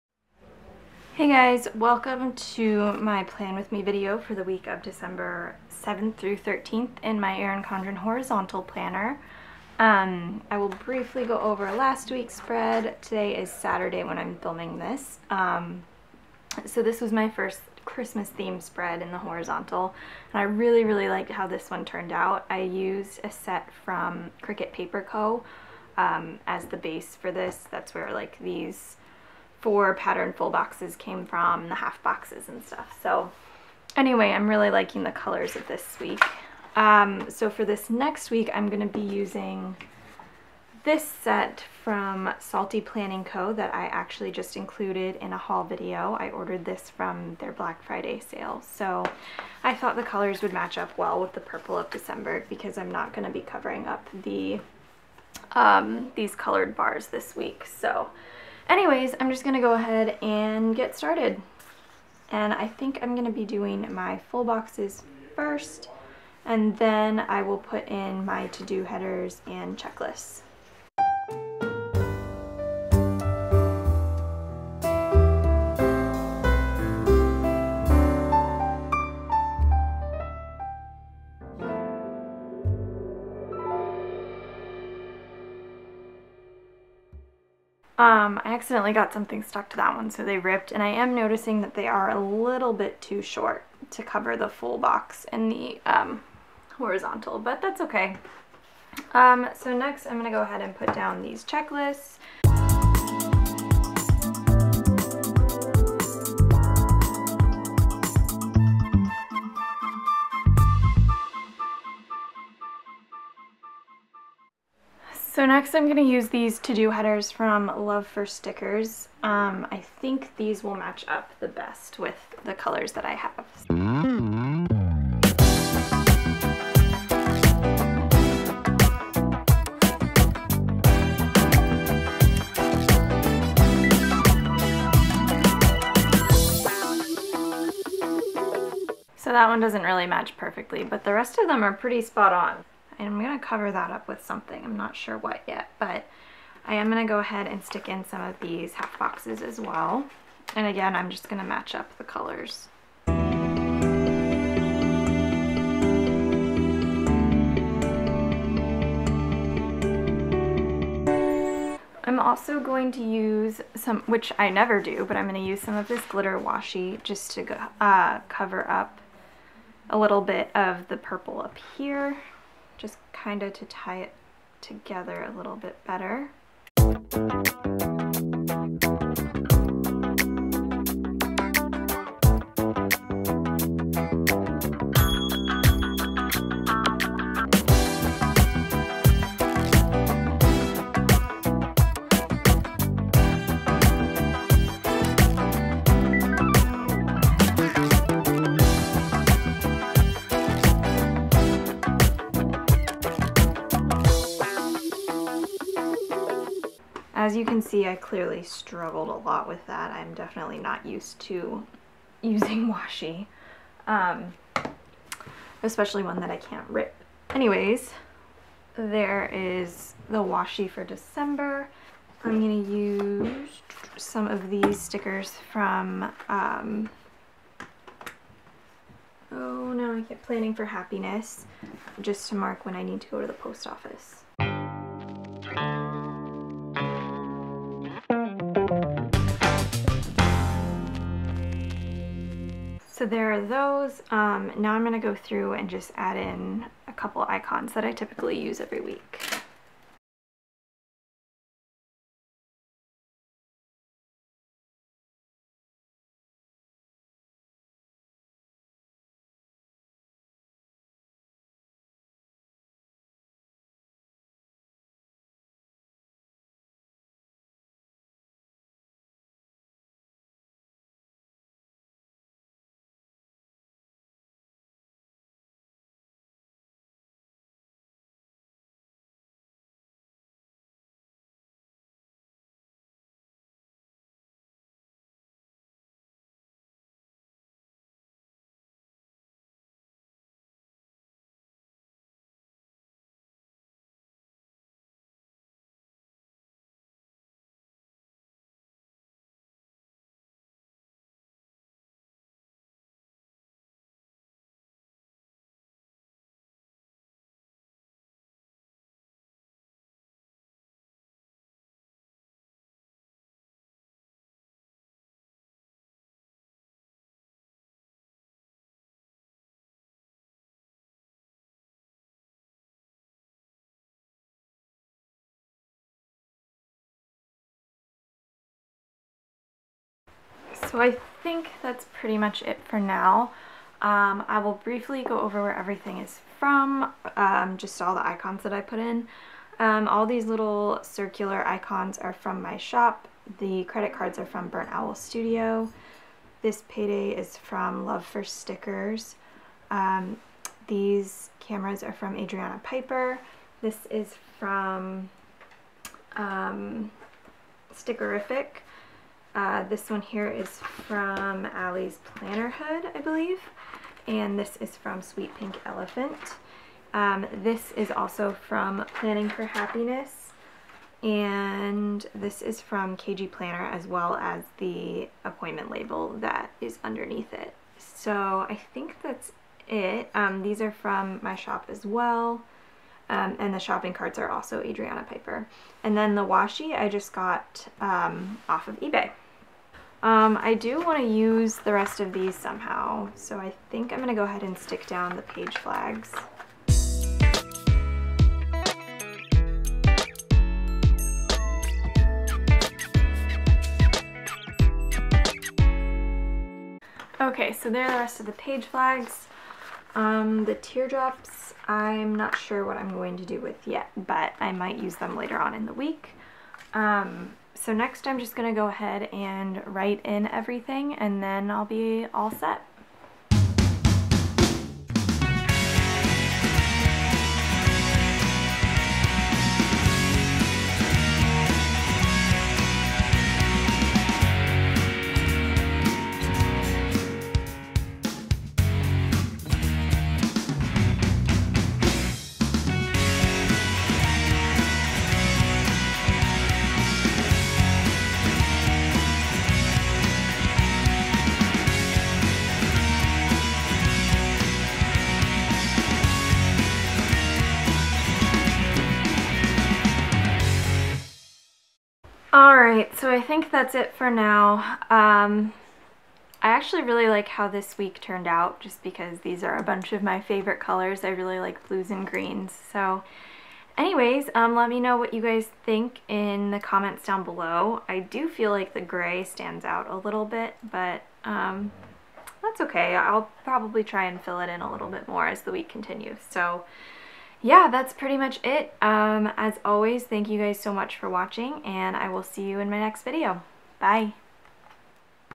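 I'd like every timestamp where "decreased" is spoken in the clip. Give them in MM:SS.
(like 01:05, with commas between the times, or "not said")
not said.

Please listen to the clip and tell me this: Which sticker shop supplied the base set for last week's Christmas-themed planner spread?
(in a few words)
Cricut Paper Co.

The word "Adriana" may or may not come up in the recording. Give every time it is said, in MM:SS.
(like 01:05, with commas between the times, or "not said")
05:52, 06:24.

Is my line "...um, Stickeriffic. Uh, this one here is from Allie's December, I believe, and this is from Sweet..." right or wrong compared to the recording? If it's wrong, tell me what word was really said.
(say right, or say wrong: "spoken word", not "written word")
wrong: "Plannerhood", not "December".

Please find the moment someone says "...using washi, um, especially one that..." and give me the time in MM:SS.
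03:32.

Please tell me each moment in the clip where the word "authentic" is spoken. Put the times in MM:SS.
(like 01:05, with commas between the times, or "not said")
not said.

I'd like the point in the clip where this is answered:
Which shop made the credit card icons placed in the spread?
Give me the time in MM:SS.
05:44.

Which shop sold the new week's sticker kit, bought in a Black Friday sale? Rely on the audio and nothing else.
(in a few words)
Salty Planning Co.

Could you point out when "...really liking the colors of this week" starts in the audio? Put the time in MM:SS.
00:34.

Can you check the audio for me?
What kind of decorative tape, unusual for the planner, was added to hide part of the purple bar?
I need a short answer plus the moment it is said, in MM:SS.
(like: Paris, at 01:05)
glitter washi, at 02:46.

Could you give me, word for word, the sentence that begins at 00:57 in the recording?
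So Anyways, I'm just going to go ahead and get started.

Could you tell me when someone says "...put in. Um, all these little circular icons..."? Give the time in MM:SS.
05:38.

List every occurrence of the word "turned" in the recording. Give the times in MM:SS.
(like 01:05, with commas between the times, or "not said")
00:21, 07:48.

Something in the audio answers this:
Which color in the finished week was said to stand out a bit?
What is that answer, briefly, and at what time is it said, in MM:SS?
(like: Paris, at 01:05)
gray, at 07:58.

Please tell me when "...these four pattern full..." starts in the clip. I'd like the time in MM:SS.
00:28.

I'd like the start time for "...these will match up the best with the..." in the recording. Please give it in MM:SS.
02:00.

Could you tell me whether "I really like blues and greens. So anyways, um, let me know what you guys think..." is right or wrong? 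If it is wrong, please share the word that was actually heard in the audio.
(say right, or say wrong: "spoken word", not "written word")
right.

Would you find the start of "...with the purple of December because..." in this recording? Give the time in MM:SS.
00:51.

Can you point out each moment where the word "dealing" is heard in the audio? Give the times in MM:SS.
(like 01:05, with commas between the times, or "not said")
not said.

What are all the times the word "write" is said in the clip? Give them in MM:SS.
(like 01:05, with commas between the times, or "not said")
06:59.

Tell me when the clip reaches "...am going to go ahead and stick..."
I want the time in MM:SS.
02:26.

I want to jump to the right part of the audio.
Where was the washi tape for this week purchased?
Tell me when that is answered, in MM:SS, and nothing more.
06:28.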